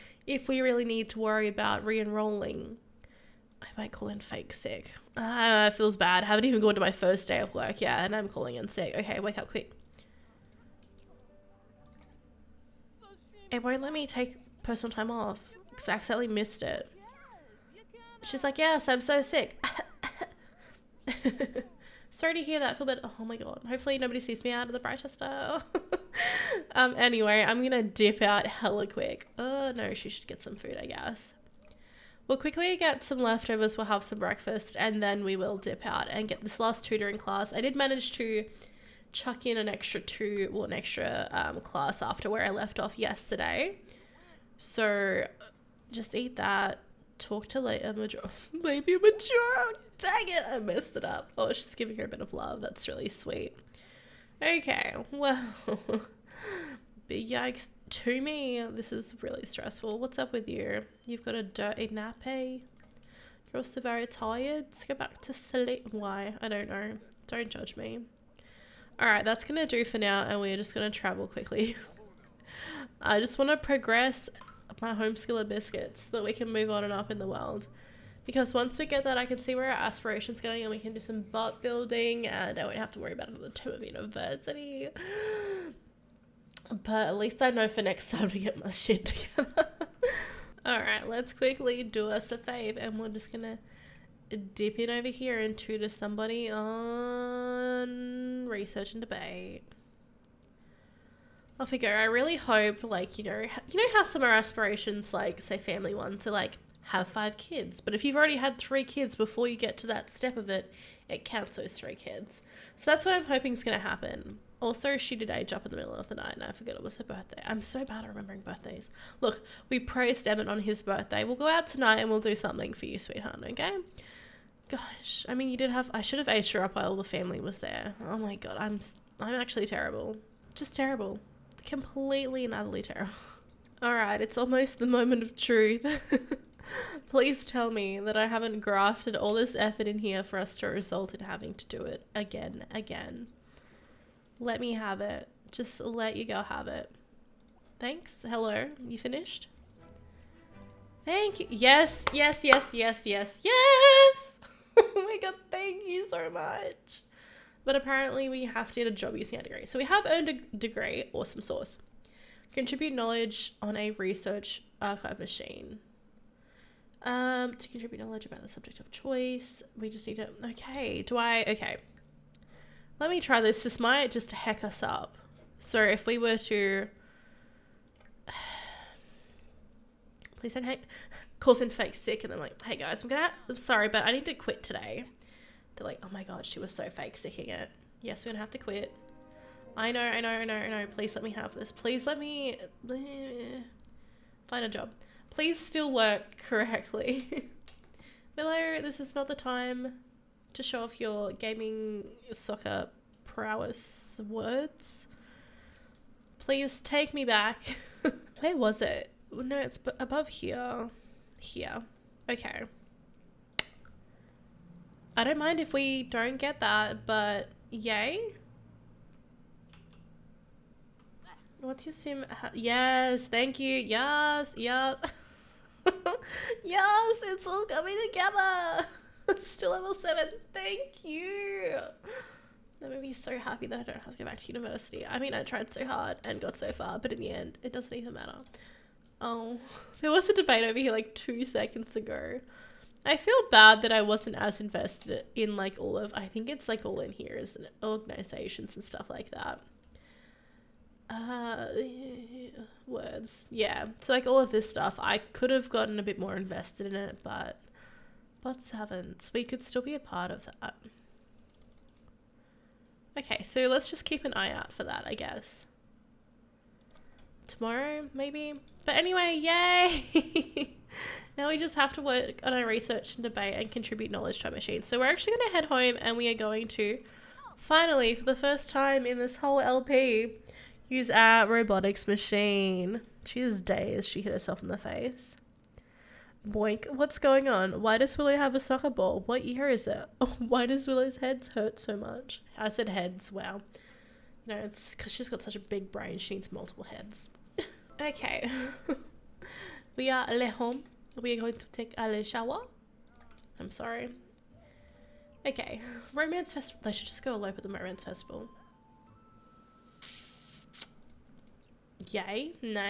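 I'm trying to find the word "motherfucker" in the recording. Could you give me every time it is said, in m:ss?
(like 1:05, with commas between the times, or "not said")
not said.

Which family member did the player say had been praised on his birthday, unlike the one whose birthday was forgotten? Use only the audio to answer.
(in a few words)
Emmett.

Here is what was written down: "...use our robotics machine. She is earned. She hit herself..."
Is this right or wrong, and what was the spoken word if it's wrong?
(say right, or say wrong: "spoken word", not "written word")
wrong: "dazed", not "earned".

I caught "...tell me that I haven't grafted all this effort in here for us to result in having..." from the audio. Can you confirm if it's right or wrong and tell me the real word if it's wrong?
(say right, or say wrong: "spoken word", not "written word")
right.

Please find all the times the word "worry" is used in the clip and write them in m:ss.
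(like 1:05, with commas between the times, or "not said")
0:01, 1:22.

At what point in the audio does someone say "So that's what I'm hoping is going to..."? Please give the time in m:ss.
1:52.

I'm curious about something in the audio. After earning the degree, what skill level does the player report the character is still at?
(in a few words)
7.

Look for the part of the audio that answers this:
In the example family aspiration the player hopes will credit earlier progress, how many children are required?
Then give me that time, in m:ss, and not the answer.
1:47.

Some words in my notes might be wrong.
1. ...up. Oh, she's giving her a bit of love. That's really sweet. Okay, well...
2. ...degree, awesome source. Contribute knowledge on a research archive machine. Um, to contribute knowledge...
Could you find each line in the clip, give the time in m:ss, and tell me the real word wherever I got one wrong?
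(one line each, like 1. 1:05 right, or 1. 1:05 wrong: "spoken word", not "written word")
1. 0:51 right
2. 2:40 right.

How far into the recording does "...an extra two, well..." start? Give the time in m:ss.
0:39.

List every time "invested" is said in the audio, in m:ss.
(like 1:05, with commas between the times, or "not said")
4:04, 4:16.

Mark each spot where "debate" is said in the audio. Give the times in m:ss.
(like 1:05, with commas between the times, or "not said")
1:38, 4:00, 4:33.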